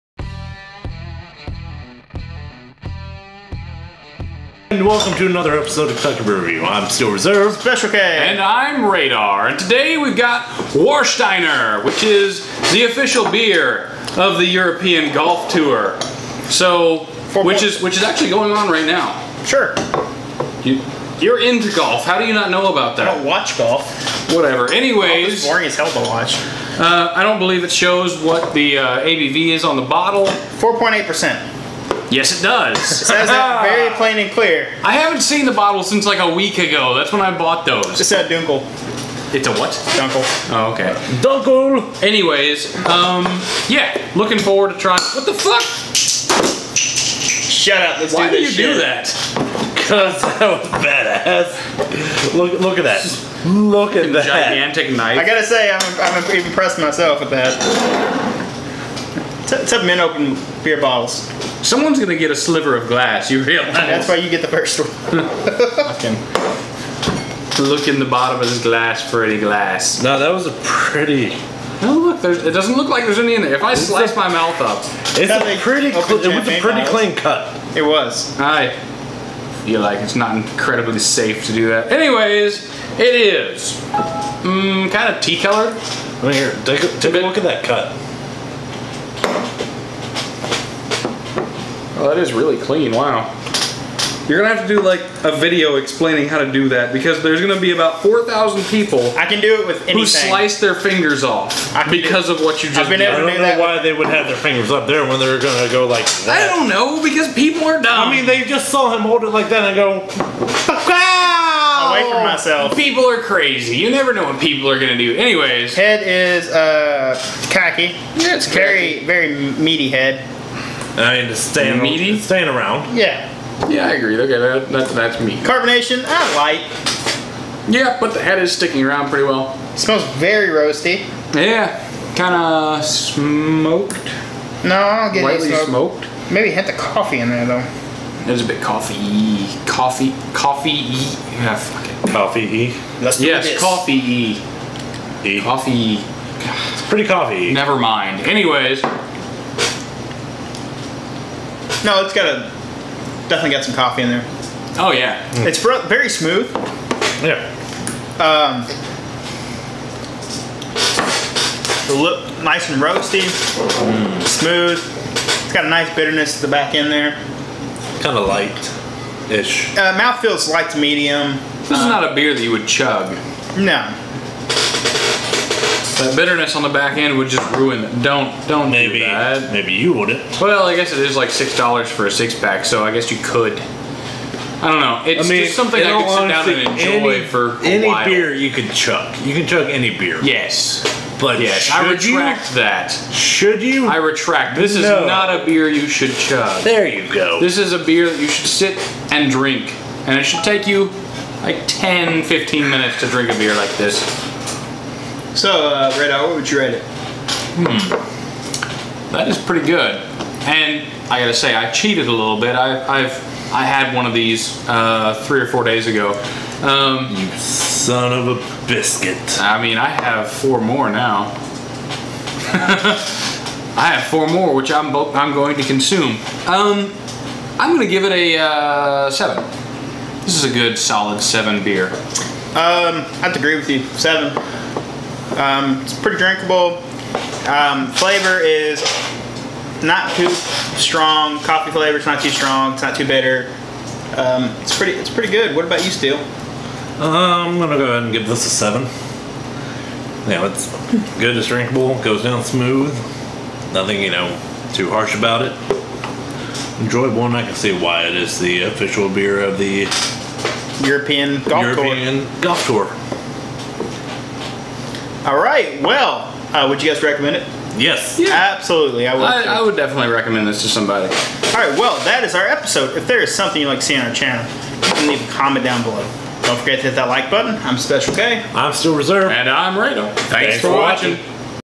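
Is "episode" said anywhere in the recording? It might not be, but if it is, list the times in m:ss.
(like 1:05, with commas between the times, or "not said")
0:05, 4:32.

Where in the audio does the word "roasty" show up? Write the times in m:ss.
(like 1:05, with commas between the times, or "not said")
2:10, 2:42.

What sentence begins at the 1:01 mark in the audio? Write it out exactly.
Someone's gonna get a sliver of glass.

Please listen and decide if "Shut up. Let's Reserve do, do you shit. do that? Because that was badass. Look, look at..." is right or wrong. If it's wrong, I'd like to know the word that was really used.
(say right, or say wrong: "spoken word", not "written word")
wrong: "Why", not "Reserve".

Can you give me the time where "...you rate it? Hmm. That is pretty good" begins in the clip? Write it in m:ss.
3:26.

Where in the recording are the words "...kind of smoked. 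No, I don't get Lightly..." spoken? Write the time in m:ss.
2:12.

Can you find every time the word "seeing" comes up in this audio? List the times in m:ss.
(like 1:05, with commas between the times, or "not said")
4:33.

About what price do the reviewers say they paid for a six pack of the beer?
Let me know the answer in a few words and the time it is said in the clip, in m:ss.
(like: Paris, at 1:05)
6 dollars, at 3:01.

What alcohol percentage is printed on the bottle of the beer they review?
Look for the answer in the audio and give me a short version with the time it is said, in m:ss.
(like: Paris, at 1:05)
4.8%, at 0:30.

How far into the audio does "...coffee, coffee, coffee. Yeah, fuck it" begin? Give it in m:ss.
2:18.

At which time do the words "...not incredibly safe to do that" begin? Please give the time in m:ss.
1:20.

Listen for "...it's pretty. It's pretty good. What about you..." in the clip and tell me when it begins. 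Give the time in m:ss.
4:04.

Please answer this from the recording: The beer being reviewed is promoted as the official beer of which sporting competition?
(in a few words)
European Golf Tour.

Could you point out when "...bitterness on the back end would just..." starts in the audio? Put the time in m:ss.
2:56.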